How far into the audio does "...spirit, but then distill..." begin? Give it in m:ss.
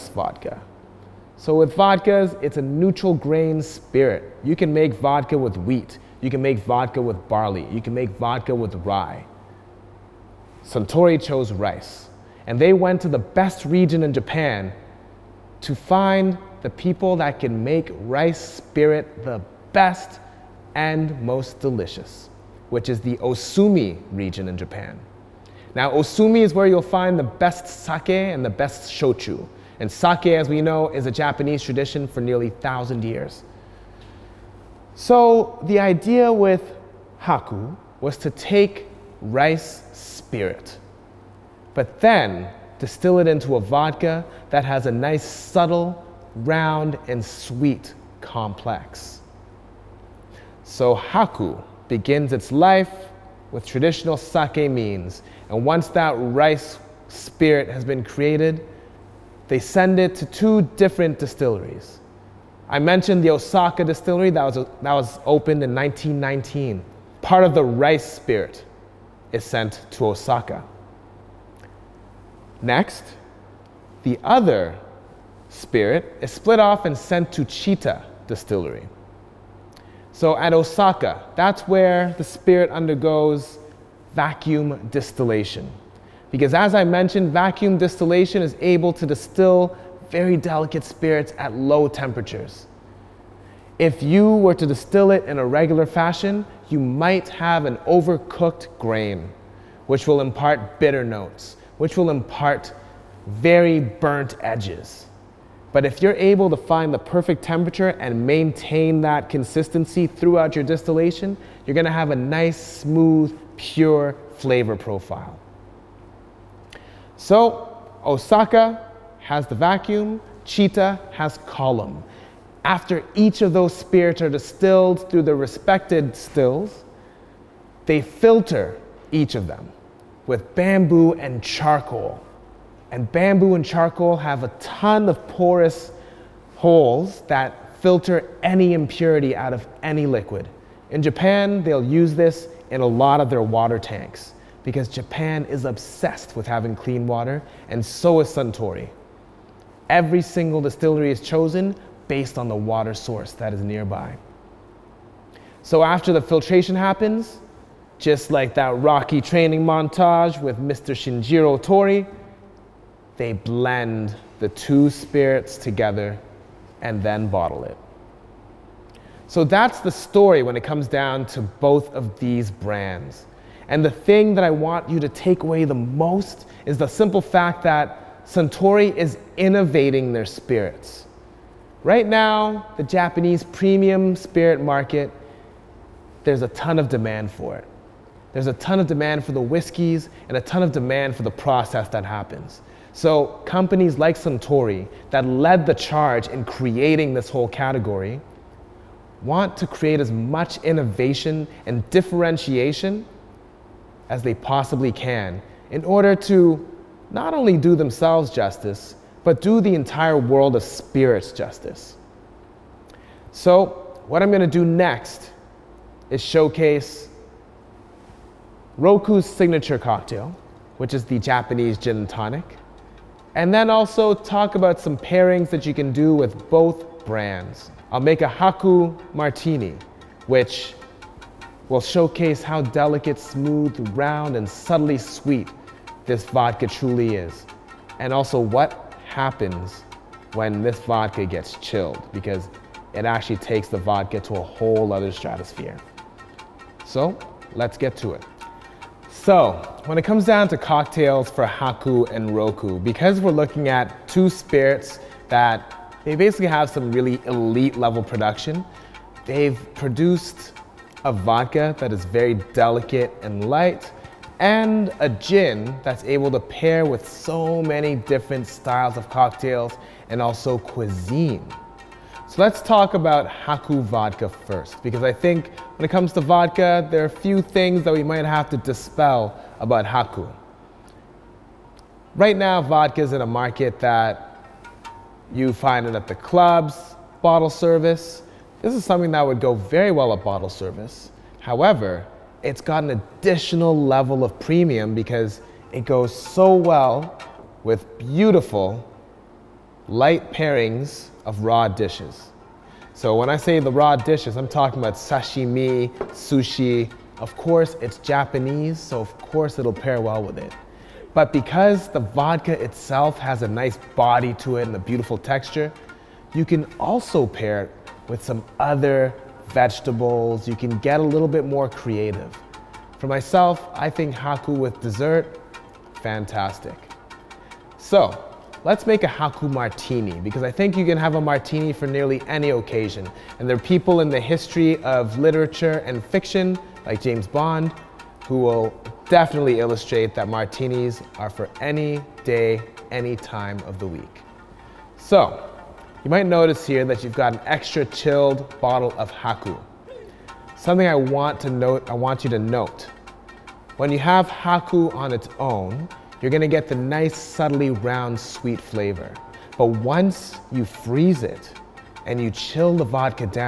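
0:39.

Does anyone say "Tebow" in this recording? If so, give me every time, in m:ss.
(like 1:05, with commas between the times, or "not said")
not said.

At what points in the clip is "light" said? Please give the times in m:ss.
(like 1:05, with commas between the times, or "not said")
4:23, 4:59.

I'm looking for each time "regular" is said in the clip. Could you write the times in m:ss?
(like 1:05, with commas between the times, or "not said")
1:35.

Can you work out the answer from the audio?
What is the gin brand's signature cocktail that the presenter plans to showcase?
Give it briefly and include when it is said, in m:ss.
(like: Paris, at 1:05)
Japanese gin and tonic, at 3:41.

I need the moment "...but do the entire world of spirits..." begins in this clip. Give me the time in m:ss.
3:29.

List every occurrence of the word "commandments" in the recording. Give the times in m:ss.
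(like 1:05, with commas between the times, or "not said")
not said.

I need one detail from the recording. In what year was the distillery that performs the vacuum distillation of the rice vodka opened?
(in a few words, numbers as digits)
1919.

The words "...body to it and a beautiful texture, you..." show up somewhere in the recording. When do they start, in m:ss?
5:13.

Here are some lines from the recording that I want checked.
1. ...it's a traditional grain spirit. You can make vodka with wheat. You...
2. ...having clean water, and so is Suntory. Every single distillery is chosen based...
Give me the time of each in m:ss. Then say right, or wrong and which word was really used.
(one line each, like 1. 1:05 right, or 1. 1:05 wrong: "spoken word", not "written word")
1. 0:02 wrong: "neutral", not "traditional"
2. 2:26 right.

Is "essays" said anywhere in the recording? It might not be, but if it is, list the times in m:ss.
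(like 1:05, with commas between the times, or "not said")
not said.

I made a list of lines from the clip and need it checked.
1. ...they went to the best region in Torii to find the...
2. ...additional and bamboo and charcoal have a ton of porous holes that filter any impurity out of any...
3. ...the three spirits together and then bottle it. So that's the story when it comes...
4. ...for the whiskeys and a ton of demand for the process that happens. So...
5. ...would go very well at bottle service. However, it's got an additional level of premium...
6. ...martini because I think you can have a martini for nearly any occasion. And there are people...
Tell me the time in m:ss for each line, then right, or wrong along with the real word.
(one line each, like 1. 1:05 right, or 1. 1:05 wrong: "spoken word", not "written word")
1. 0:12 wrong: "Japan", not "Torii"
2. 2:11 wrong: "charcoal", not "additional"
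3. 2:44 wrong: "two", not "three"
4. 3:09 right
5. 4:49 right
6. 5:29 right.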